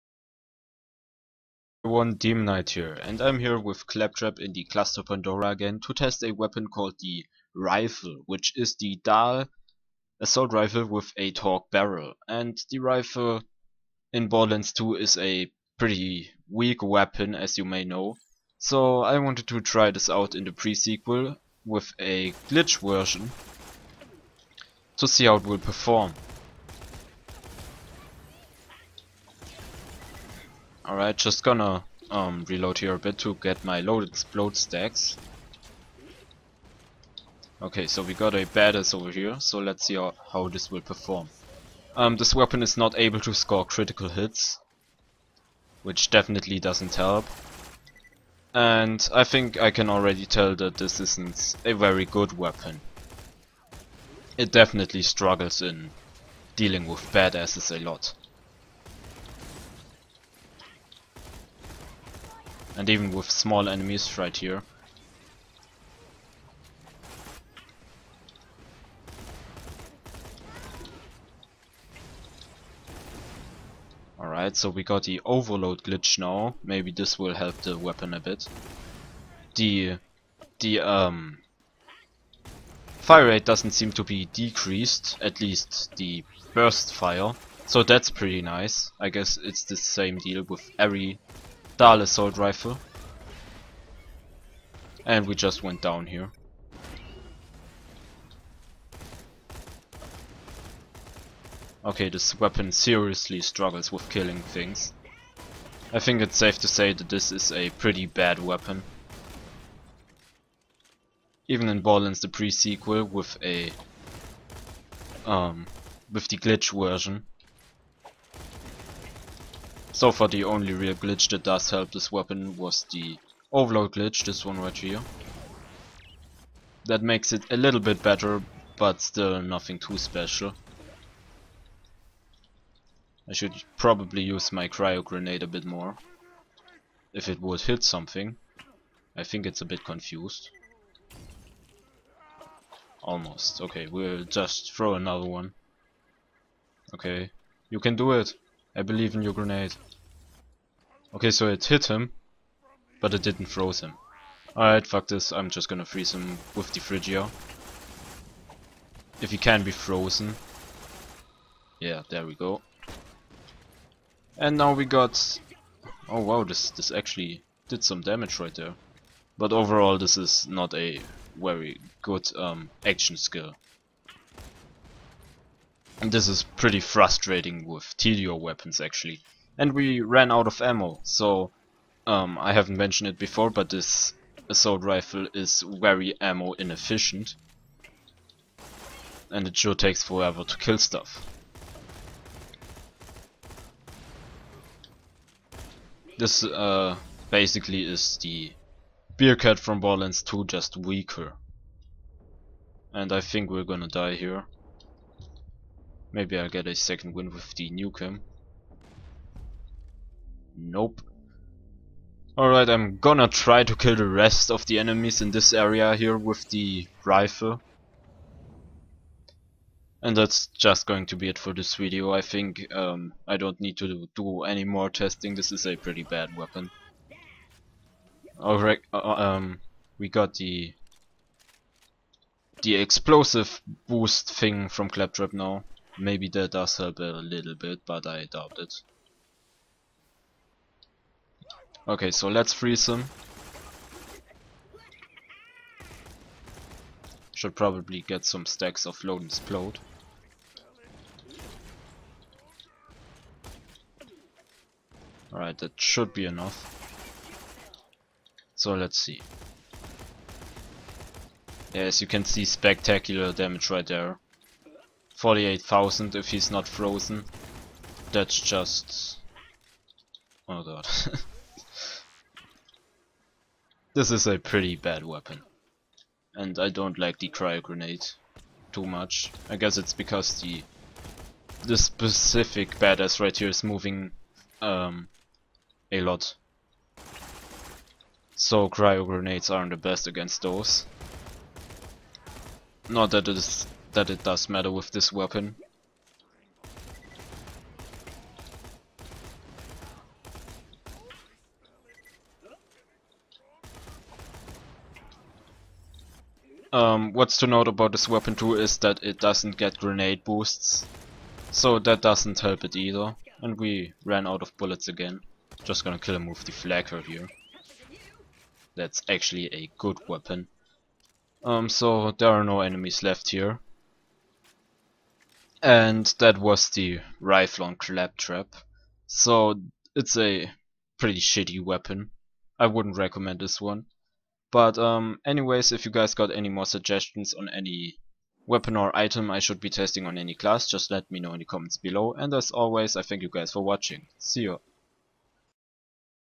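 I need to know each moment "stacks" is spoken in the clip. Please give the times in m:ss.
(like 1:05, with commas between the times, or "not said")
0:34, 4:08.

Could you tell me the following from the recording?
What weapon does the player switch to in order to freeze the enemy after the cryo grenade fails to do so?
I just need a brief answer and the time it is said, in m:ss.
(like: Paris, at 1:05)
Fridgia, at 2:36.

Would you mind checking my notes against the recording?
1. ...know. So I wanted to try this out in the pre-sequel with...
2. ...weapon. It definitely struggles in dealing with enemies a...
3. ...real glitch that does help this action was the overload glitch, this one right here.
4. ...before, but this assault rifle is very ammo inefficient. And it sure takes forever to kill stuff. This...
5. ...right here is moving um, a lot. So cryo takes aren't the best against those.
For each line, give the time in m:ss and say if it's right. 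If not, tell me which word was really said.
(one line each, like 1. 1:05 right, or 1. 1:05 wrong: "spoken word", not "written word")
1. 0:17 right
2. 0:52 wrong: "badasses", not "enemies"
3. 2:00 wrong: "weapon", not "action"
4. 3:03 right
5. 4:43 wrong: "grenades", not "takes".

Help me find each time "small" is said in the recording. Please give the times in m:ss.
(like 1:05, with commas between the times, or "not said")
1:03.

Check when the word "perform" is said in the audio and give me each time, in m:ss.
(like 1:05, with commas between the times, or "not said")
0:25, 0:40.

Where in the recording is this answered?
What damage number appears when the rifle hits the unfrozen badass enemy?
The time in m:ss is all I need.
4:25.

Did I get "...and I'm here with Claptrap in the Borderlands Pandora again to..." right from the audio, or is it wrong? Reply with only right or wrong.
wrong.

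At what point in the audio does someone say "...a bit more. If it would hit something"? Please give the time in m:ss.
2:15.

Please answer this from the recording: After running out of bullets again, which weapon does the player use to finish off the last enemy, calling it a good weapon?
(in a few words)
Flakker.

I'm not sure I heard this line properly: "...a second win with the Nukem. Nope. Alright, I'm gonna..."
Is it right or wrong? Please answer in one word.
right.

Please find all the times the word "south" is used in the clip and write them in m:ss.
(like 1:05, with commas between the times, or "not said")
not said.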